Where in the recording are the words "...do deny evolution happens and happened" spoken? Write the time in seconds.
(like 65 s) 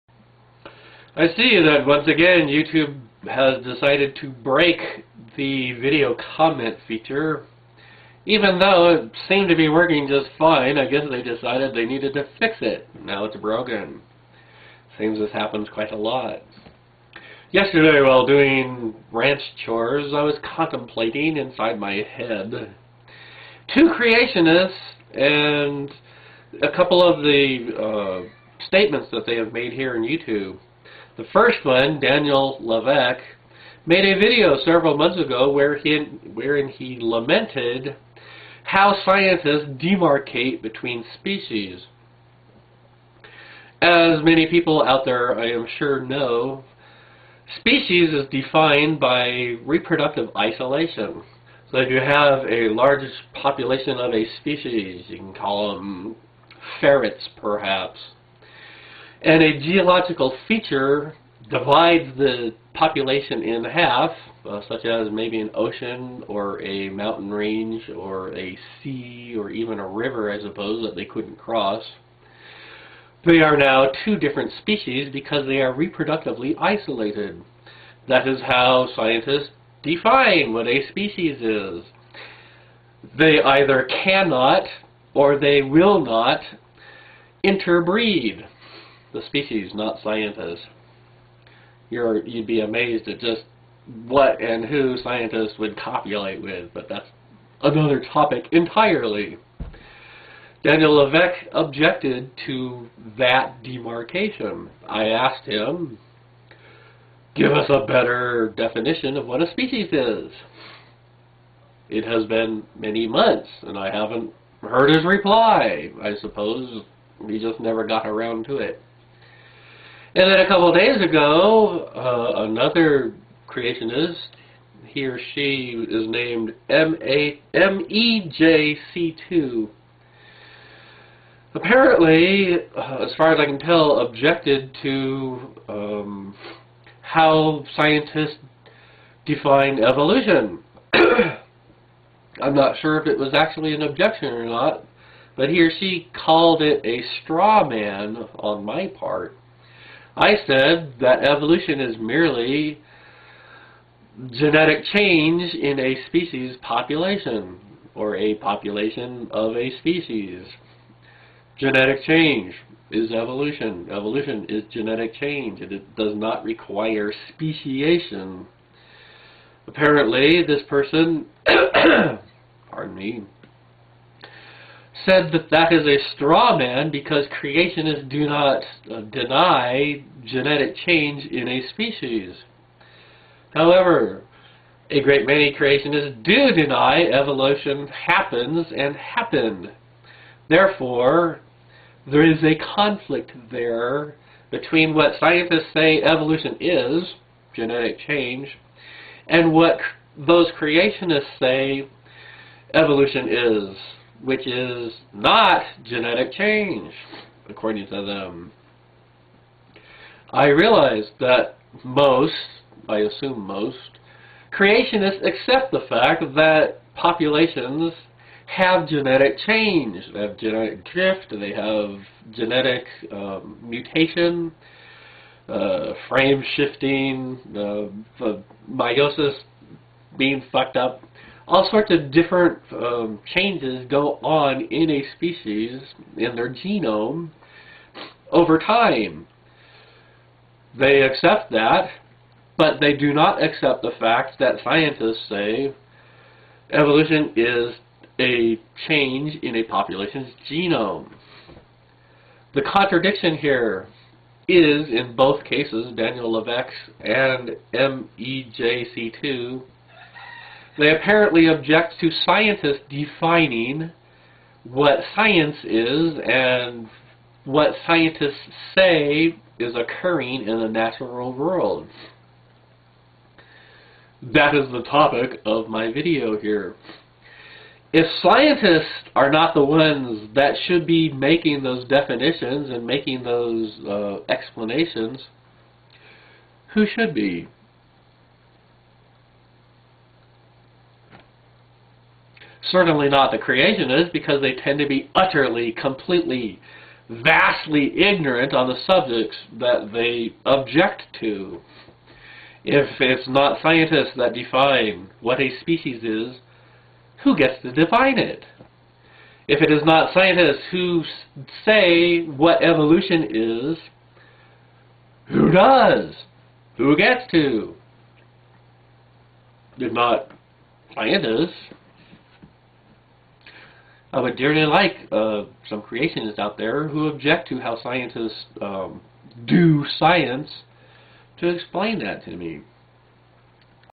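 186 s.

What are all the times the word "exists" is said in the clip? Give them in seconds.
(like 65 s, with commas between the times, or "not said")
not said.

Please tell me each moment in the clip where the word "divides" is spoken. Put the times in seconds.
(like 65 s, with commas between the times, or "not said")
61 s.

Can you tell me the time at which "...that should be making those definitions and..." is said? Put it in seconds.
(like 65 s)
280 s.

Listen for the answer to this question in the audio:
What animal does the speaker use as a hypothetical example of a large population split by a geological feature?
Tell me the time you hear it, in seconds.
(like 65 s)
56 s.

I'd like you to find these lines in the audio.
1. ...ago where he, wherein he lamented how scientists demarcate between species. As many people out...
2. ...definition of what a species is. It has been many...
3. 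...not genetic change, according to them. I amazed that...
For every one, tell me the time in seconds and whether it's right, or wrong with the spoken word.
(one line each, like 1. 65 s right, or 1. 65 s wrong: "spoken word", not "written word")
1. 35 s right
2. 108 s right
3. 205 s wrong: "realized", not "amazed".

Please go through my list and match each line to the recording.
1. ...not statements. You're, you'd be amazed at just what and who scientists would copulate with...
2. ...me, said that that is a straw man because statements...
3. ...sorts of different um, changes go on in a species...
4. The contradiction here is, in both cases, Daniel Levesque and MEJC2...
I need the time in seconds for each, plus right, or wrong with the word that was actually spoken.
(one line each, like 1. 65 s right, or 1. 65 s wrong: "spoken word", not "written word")
1. 89 s wrong: "scientists", not "statements"
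2. 172 s wrong: "creationists", not "statements"
3. 231 s right
4. 252 s right.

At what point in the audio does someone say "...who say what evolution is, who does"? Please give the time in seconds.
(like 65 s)
310 s.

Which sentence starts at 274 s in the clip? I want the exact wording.
That is the topic of my video here.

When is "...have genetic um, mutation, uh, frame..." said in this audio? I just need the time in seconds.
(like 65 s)
221 s.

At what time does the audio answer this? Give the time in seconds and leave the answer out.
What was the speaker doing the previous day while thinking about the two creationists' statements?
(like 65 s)
19 s.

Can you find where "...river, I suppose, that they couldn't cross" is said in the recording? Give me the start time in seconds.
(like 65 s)
69 s.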